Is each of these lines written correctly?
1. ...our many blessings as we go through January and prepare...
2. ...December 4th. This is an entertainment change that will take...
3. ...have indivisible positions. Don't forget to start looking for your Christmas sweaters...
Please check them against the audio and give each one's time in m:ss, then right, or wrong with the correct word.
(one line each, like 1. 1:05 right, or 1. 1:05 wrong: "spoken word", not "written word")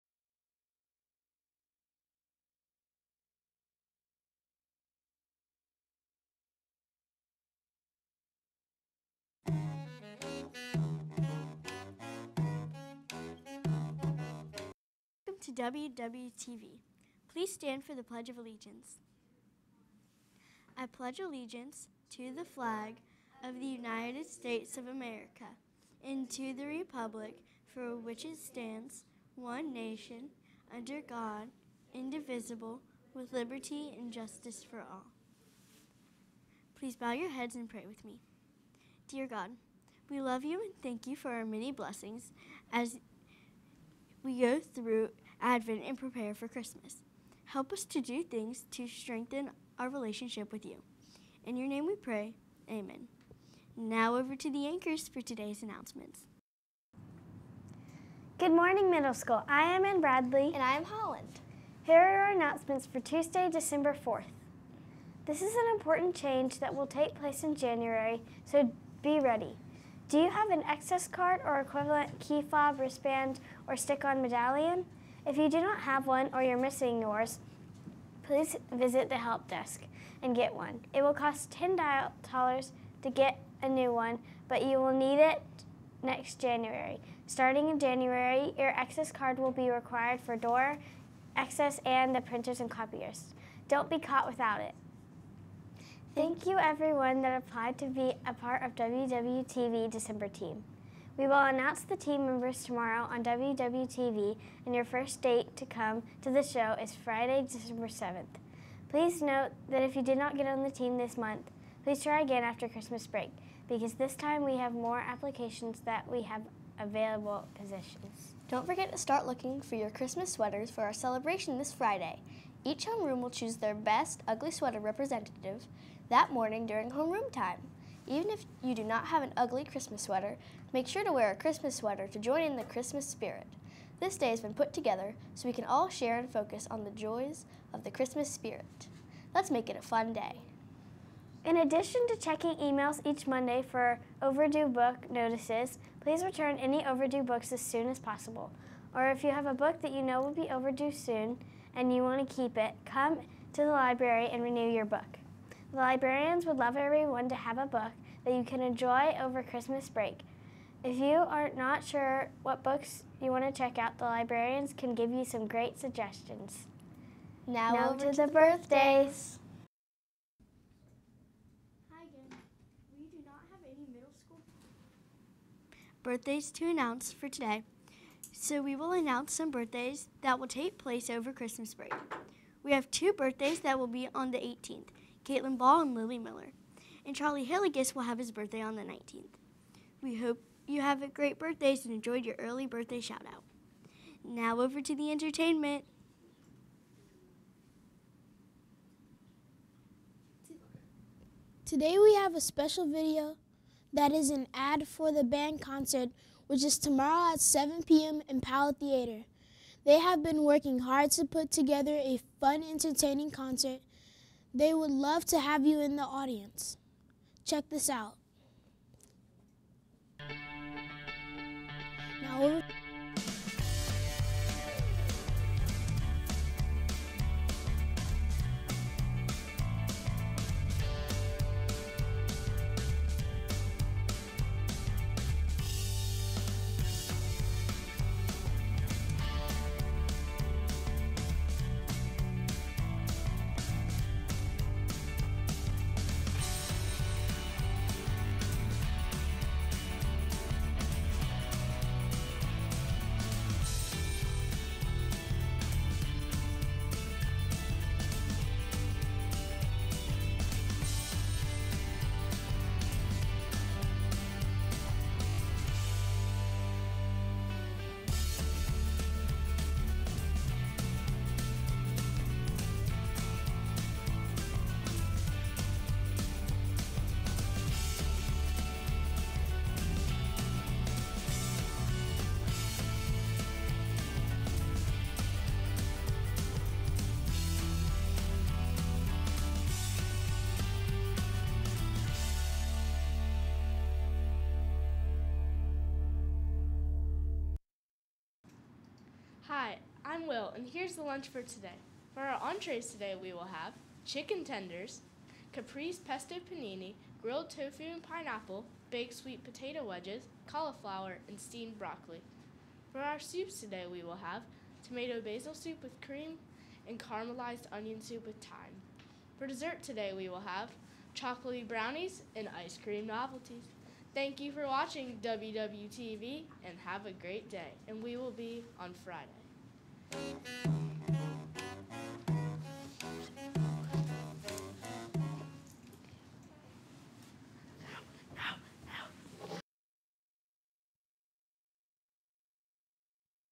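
1. 0:41 wrong: "Advent", not "January"
2. 1:03 wrong: "important", not "entertainment"
3. 1:56 wrong: "available", not "indivisible".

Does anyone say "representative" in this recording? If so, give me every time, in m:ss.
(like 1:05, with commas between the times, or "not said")
2:04.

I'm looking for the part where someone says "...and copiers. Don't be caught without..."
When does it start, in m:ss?
1:32.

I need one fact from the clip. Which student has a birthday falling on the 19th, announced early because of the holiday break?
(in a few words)
Charlie Hilligus.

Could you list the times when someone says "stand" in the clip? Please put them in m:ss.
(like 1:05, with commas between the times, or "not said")
0:17, 0:28.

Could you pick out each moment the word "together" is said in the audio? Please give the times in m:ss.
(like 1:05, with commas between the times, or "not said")
2:14, 3:31.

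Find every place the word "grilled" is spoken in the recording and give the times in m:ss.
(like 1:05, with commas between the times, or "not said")
5:07.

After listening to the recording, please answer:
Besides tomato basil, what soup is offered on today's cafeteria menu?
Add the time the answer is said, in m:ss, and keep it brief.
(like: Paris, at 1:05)
caramelized onion soup with thyme, at 5:16.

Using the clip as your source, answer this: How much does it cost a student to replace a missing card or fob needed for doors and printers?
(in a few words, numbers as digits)
$10.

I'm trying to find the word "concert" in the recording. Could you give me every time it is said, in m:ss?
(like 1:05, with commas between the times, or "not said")
3:25, 3:33.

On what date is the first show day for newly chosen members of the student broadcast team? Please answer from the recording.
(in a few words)
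Friday, December 7th.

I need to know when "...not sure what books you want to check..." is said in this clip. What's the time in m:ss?
2:41.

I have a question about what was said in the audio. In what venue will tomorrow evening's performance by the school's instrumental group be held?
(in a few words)
Powell Theater.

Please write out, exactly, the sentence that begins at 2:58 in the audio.
So we will announce some birthdays that will take place over Christmas break.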